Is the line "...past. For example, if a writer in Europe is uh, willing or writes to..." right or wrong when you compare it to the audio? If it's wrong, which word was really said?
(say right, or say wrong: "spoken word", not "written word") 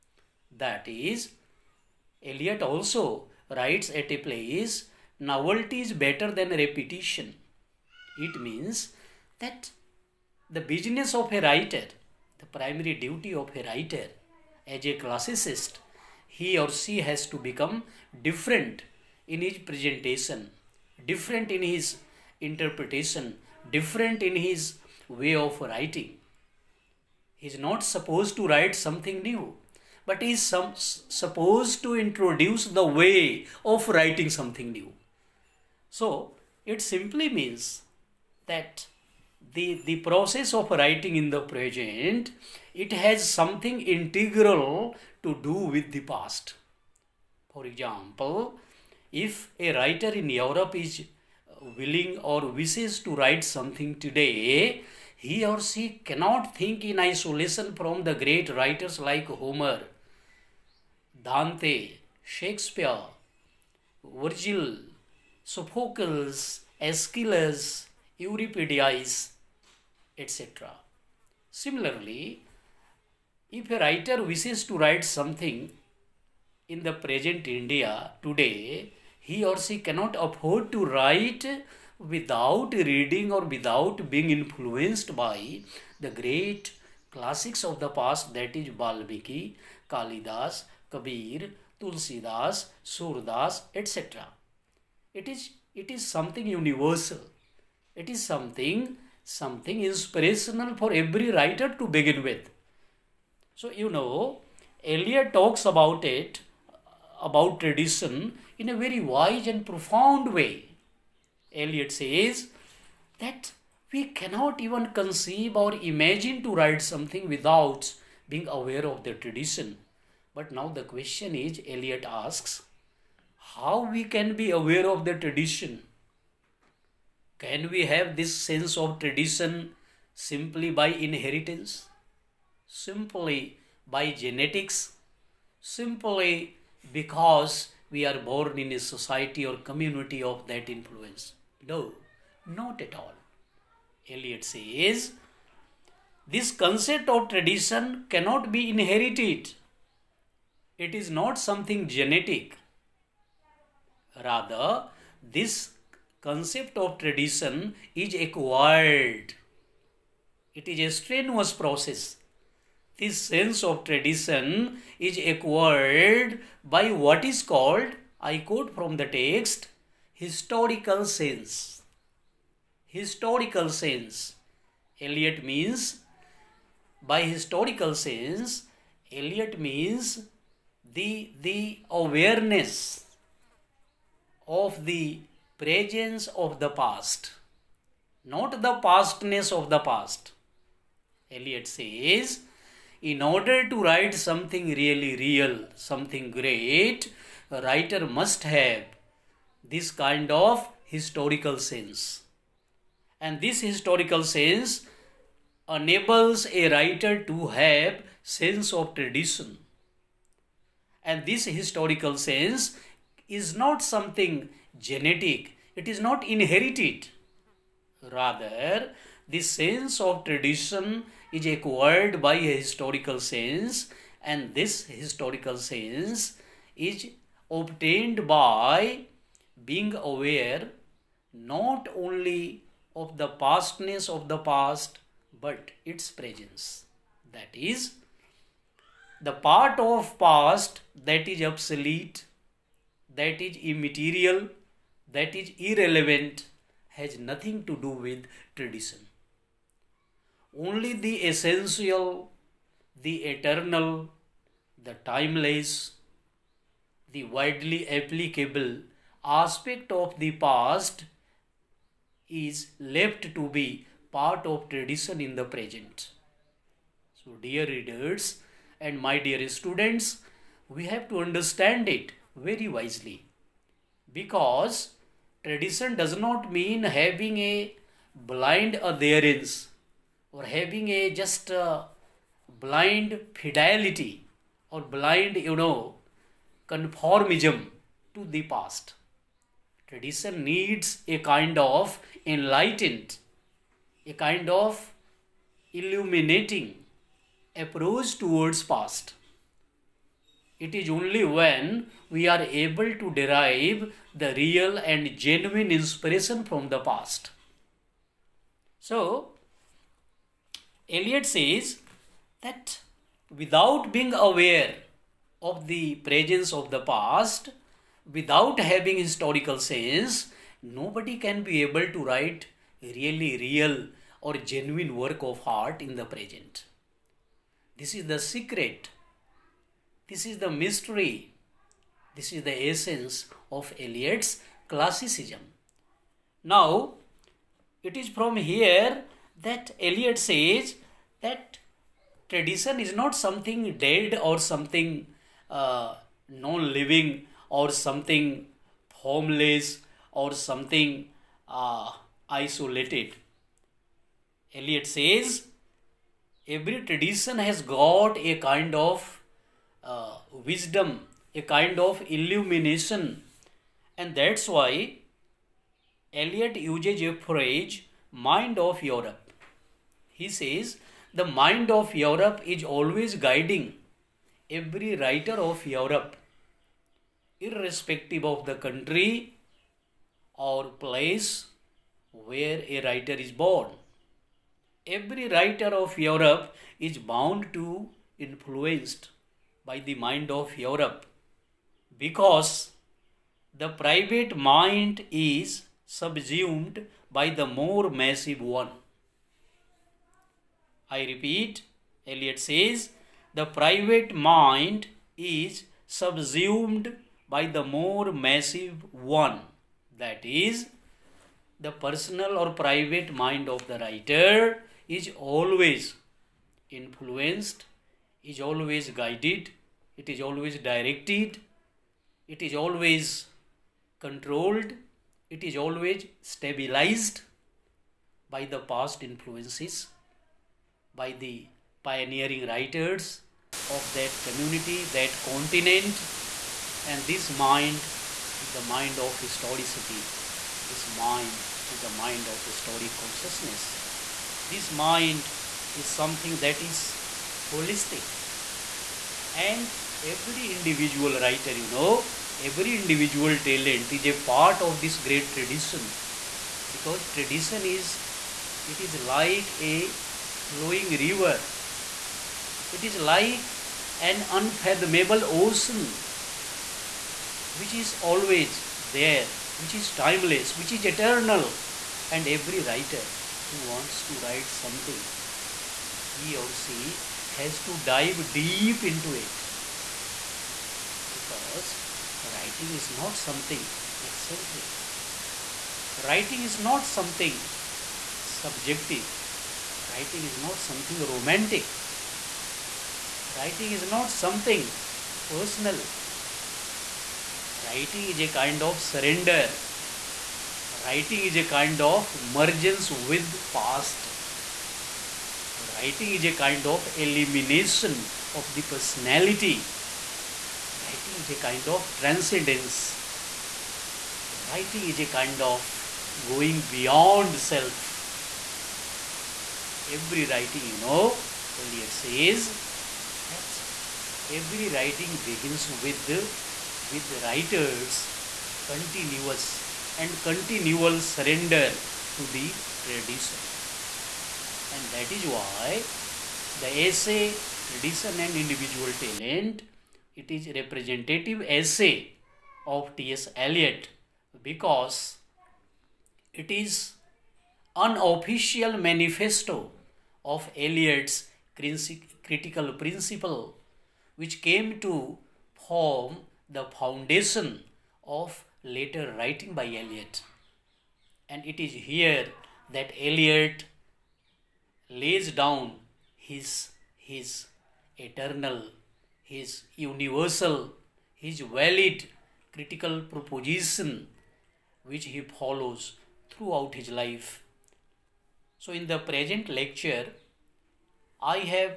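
wrong: "wishes", not "writes".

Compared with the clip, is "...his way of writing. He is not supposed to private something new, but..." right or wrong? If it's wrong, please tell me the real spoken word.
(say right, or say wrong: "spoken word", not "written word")
wrong: "write", not "private".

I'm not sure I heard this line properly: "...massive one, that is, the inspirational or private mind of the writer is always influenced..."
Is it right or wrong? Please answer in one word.
wrong.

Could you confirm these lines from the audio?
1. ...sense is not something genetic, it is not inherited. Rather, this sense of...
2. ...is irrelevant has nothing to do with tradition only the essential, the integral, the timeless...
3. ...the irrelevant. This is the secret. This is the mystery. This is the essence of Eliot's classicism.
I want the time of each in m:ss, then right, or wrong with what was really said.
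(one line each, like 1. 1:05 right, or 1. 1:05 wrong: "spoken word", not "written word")
1. 3:32 right
2. 4:05 wrong: "eternal", not "integral"
3. 5:25 wrong: "present", not "irrelevant".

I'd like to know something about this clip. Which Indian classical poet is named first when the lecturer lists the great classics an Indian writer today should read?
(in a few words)
Balmiki.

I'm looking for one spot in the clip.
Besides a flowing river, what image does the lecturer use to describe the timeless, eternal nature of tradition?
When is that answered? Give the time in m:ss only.
7:44.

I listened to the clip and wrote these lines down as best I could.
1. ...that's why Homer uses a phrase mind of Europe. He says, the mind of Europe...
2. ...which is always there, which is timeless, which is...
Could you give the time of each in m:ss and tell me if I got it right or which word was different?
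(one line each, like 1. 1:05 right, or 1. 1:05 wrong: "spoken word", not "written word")
1. 6:04 wrong: "Eliot", not "Homer"
2. 7:47 right.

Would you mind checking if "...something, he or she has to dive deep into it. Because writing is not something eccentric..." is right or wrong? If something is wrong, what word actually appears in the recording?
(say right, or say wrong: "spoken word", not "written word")
right.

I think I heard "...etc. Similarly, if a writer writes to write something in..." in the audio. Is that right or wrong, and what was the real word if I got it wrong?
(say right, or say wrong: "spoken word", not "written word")
wrong: "wishes", not "writes".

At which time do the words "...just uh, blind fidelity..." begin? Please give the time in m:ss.
4:41.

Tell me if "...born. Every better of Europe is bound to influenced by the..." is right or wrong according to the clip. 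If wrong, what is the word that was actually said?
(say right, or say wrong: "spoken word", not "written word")
wrong: "writer", not "better".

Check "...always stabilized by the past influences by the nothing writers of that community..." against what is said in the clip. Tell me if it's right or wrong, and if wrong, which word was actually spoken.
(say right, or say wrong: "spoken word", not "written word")
wrong: "pioneering", not "nothing".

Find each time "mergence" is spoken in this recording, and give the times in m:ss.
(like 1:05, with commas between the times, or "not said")
8:22.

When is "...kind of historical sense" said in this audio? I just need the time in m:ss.
3:19.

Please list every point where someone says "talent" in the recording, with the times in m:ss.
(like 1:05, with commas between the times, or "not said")
7:33, 8:58.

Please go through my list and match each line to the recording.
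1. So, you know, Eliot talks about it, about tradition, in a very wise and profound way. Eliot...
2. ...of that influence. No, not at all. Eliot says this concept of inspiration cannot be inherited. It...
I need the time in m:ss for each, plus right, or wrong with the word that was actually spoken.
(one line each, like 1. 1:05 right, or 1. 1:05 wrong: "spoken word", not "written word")
1. 1:43 right
2. 2:20 wrong: "tradition", not "inspiration".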